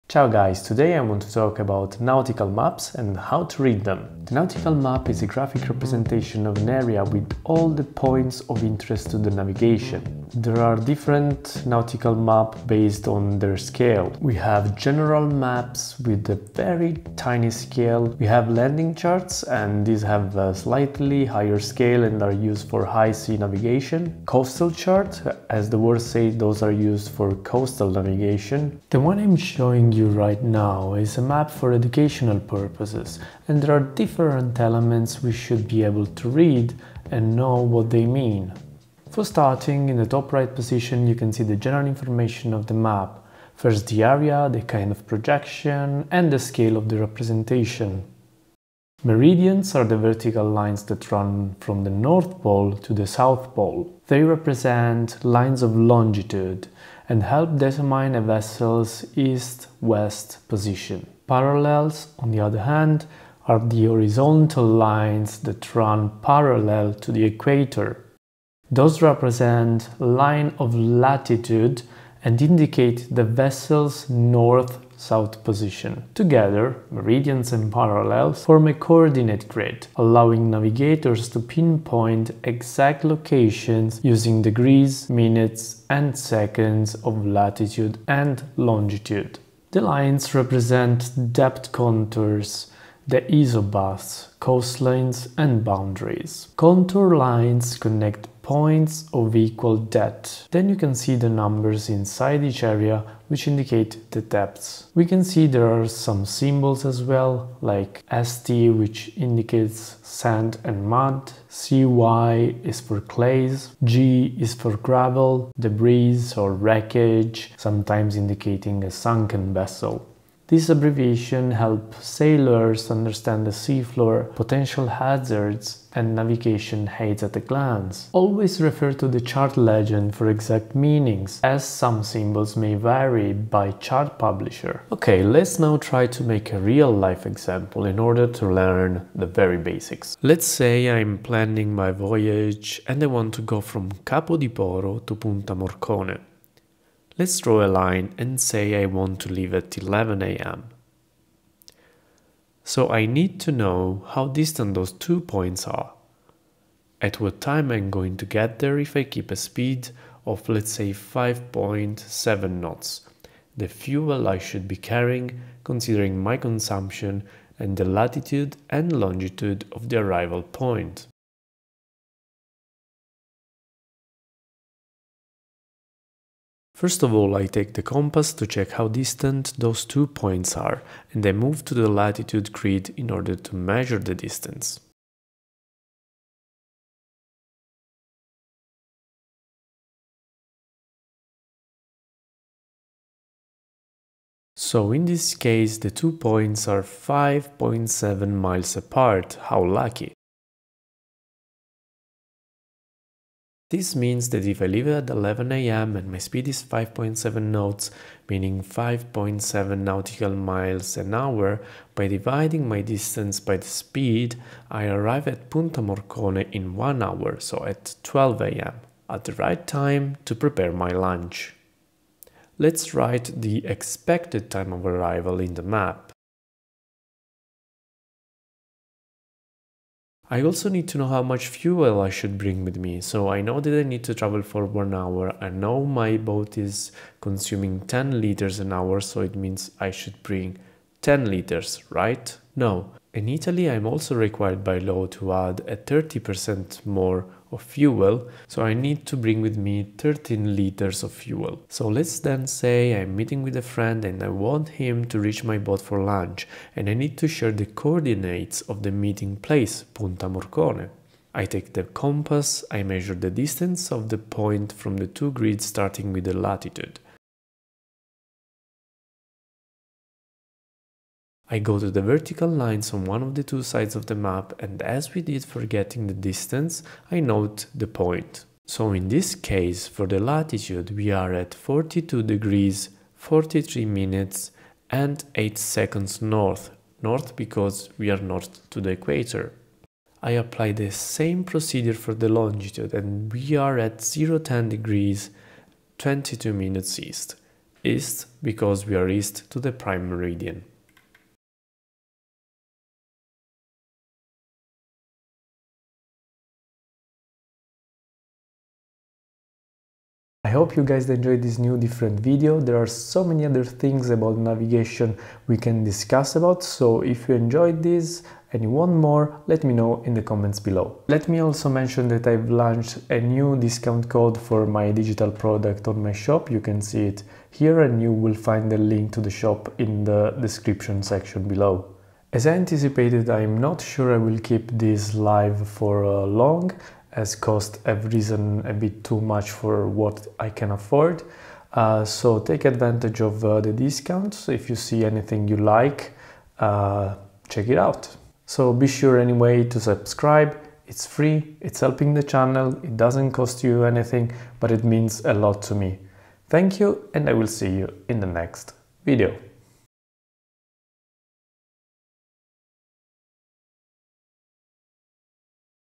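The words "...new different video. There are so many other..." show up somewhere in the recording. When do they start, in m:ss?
5:11.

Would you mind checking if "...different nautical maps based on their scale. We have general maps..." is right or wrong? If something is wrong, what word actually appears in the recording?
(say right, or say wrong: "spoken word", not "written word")
right.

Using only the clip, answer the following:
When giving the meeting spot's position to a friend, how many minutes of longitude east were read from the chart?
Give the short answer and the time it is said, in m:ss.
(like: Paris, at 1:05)
22 minutes, at 4:55.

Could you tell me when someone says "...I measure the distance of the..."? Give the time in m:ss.
4:22.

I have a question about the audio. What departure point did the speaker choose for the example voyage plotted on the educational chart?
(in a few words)
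Capo di Poro.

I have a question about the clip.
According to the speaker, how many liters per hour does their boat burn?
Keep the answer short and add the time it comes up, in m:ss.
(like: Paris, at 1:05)
10 liters, at 3:57.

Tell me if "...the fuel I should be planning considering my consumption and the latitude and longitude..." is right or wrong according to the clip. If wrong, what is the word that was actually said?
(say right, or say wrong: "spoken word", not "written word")
wrong: "carrying", not "planning".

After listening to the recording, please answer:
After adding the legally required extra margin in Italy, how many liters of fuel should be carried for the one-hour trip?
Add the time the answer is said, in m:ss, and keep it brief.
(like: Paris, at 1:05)
13 liters, at 4:09.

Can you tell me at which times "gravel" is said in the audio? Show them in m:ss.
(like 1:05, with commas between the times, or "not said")
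1:54.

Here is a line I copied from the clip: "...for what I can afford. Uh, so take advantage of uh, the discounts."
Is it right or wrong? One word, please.
right.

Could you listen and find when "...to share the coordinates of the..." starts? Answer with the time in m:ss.
4:17.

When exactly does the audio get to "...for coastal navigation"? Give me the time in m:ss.
0:27.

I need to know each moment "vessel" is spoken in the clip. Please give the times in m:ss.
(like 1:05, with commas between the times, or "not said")
0:58, 1:13, 1:59.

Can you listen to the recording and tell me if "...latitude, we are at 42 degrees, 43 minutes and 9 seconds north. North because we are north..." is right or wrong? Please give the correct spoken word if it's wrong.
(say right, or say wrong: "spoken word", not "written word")
wrong: "8", not "9".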